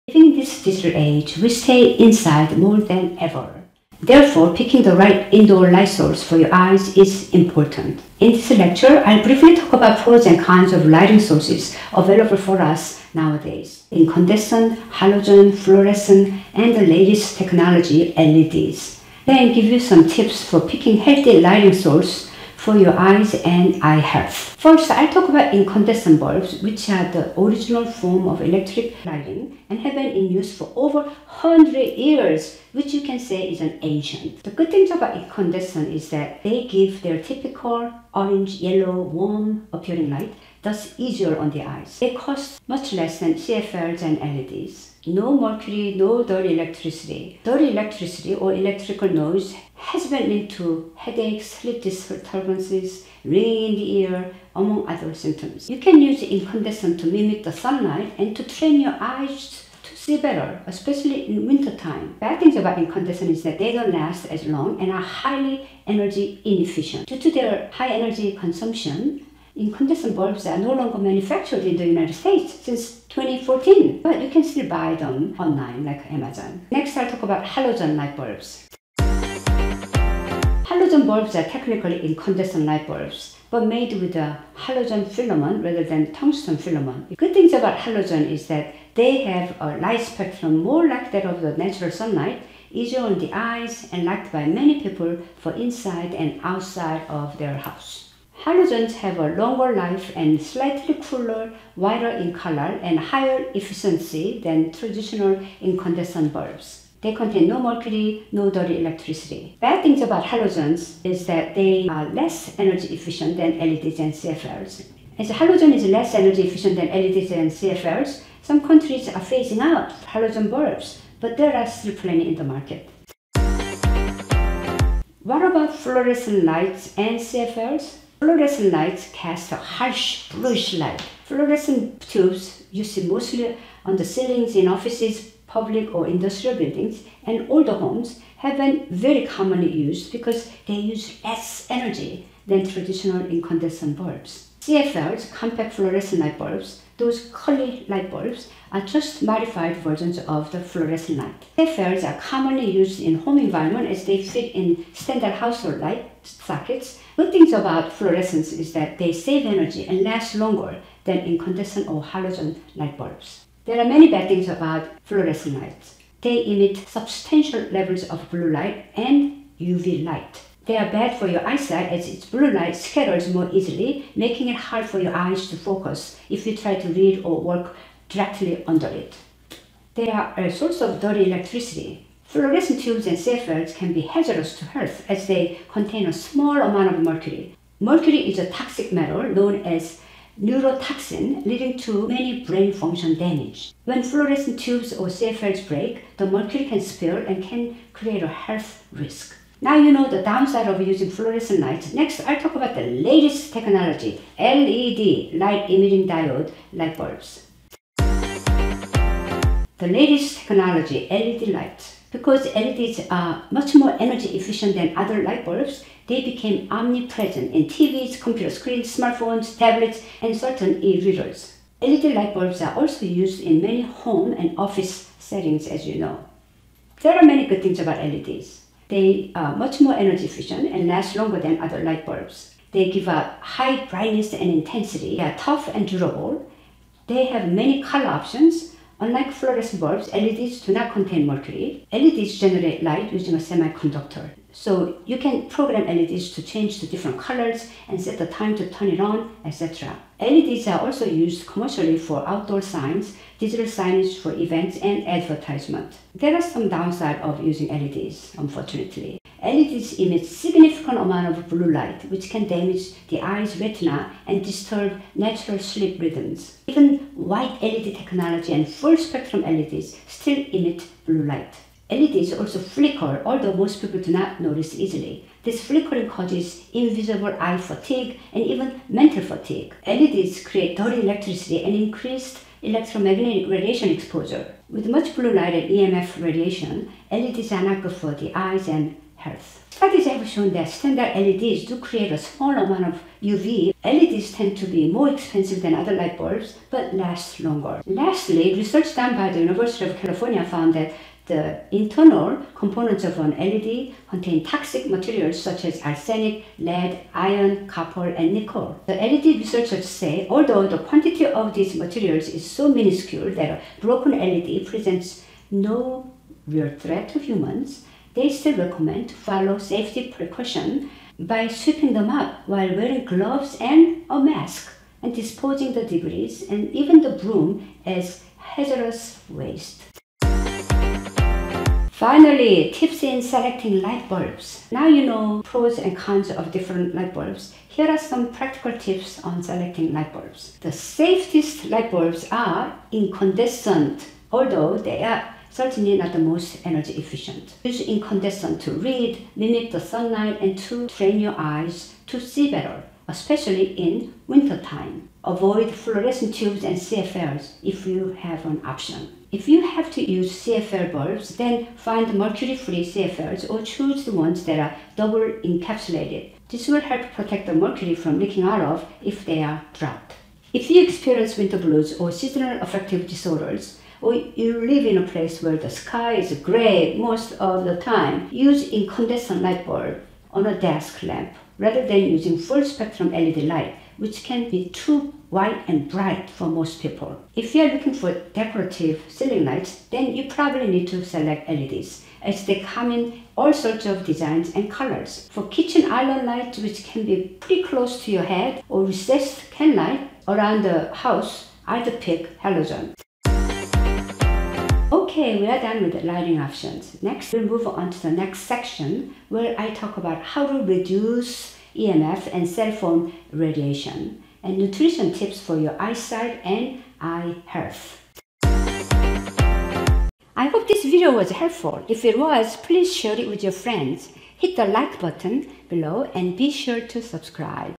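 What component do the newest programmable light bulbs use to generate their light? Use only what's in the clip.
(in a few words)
a semiconductor.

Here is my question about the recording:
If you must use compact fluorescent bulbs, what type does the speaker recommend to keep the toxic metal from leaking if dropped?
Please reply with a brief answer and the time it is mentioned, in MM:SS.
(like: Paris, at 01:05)
double encapsulated, at 06:04.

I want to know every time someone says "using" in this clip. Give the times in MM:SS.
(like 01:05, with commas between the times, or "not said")
03:20, 04:03, 04:17, 06:22.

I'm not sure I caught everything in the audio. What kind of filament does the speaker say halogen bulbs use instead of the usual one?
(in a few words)
halogen filament.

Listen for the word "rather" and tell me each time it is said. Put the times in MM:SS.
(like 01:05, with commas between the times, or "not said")
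01:25, 06:21.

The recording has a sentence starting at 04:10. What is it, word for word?
LEDs are also used commercially for outdoor signs, digital signage for events, and advertisement.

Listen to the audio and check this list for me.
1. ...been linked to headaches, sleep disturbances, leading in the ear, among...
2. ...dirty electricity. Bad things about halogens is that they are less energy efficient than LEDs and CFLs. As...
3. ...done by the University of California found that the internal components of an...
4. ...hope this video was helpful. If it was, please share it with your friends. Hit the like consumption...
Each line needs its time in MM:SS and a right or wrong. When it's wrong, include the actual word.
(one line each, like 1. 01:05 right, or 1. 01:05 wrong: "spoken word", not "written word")
1. 00:50 wrong: "ringing", not "leading"
2. 01:48 right
3. 04:58 right
4. 07:00 wrong: "button", not "consumption".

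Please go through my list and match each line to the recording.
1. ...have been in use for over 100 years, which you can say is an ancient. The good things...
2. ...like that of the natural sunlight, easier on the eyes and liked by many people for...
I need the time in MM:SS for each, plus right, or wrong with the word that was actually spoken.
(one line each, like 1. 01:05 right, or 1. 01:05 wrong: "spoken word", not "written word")
1. 00:29 right
2. 01:30 right.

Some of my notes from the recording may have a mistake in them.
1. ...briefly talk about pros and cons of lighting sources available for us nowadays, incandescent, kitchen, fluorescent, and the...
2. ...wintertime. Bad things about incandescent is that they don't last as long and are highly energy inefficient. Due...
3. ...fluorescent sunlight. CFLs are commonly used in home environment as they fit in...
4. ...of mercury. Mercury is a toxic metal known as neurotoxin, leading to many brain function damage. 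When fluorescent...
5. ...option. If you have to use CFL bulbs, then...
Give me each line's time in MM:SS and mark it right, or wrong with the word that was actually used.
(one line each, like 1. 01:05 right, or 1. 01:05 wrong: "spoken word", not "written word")
1. 00:09 wrong: "halogen", not "kitchen"
2. 01:01 right
3. 02:30 wrong: "light", not "sunlight"
4. 03:06 right
5. 05:58 right.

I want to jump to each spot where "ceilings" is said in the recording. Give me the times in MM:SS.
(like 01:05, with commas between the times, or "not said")
02:14, 06:29.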